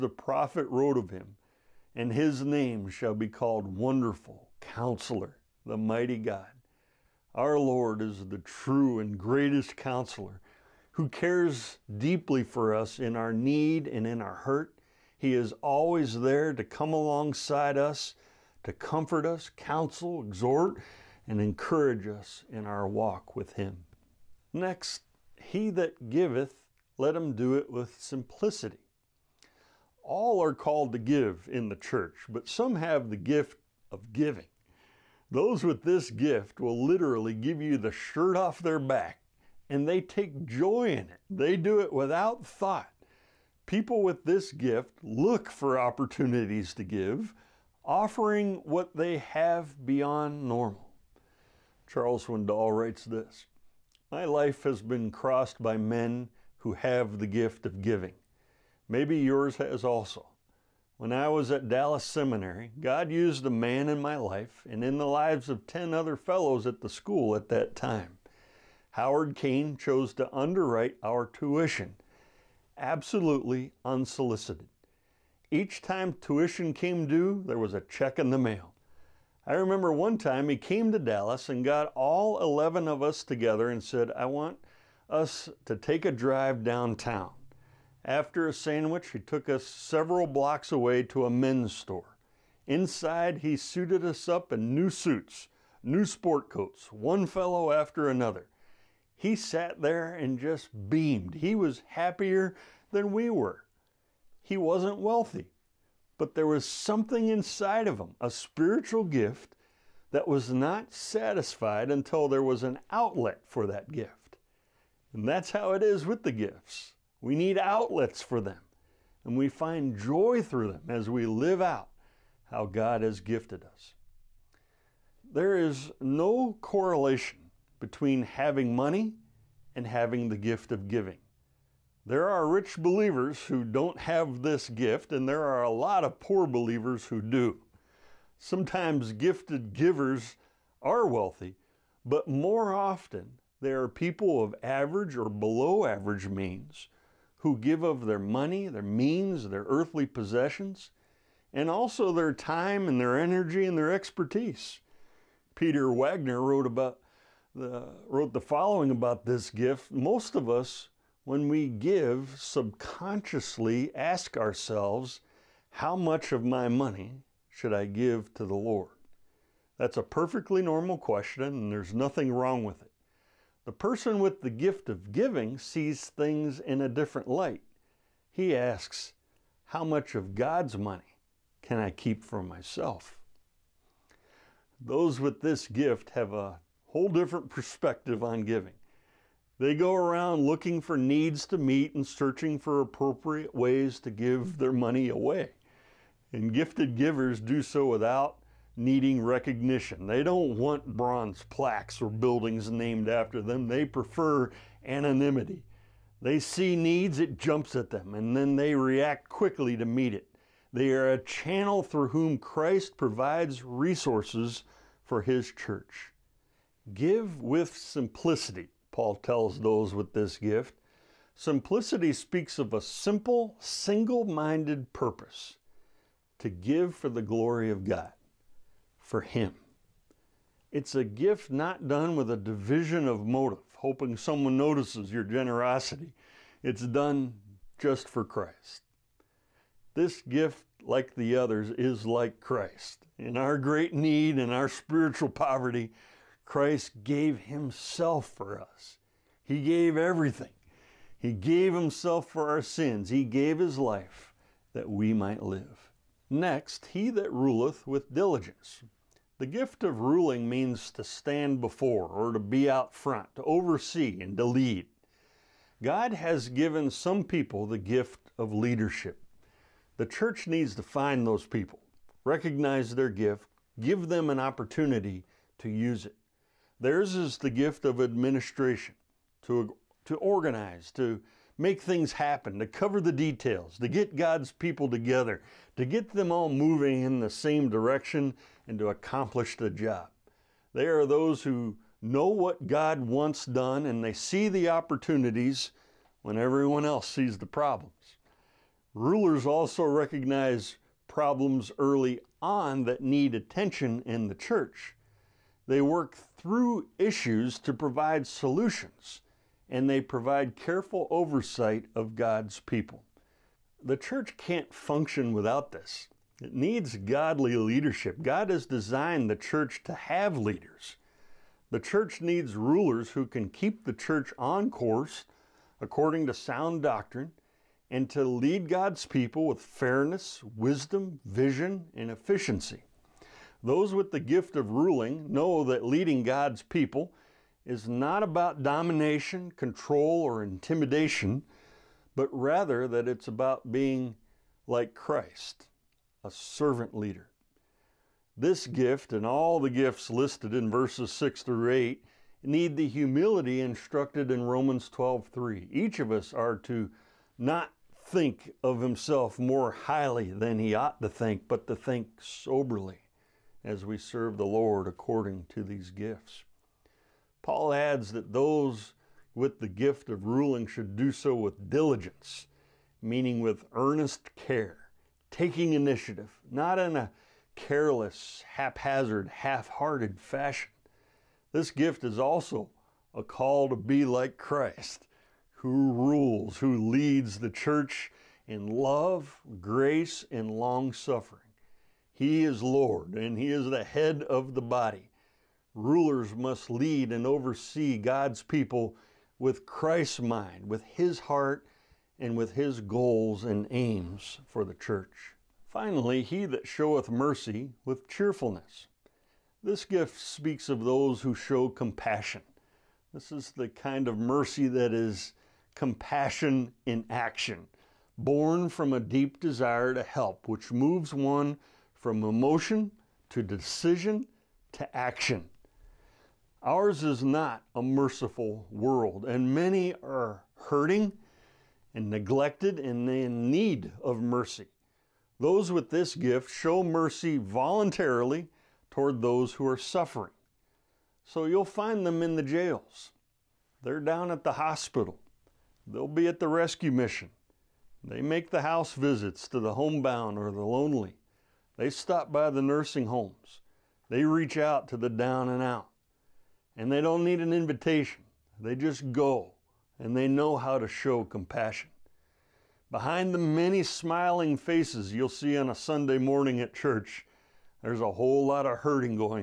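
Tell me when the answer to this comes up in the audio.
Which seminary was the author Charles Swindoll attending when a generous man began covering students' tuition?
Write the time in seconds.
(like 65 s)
61 s.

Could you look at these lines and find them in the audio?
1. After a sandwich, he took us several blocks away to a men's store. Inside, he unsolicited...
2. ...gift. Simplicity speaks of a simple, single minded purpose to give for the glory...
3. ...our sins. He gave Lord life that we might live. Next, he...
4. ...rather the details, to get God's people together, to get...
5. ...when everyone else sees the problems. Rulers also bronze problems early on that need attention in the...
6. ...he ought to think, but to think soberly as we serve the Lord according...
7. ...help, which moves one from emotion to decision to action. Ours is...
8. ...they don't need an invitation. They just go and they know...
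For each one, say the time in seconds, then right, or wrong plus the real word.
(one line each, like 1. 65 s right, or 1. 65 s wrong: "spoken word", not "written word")
1. 88 s wrong: "suited", not "unsolicited"
2. 220 s right
3. 252 s wrong: "His", not "Lord"
4. 282 s wrong: "cover", not "rather"
5. 296 s wrong: "recognize", not "bronze"
6. 360 s right
7. 420 s right
8. 456 s right.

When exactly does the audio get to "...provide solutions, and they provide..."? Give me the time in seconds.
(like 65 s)
307 s.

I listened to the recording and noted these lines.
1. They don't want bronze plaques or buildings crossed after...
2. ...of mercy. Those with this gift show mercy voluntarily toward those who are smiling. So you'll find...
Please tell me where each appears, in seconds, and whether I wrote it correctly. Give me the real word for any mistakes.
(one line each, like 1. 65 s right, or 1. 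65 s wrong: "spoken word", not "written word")
1. 200 s wrong: "named", not "crossed"
2. 434 s wrong: "suffering", not "smiling".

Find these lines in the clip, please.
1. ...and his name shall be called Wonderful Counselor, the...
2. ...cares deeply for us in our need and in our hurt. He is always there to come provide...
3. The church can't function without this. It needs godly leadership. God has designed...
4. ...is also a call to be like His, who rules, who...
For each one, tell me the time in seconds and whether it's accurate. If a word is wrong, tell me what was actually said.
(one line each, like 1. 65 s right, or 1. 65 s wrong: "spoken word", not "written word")
1. 1 s right
2. 11 s wrong: "alongside", not "provide"
3. 313 s right
4. 382 s wrong: "Christ", not "His".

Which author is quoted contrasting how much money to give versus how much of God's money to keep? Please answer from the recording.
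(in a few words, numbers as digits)
Peter Wagner.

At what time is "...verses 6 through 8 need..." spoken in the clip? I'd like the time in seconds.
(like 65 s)
350 s.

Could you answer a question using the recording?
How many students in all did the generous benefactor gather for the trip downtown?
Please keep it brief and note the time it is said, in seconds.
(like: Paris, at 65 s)
11, at 82 s.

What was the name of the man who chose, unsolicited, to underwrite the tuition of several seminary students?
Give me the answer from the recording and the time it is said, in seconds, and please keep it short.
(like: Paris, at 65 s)
Howard Kane, at 68 s.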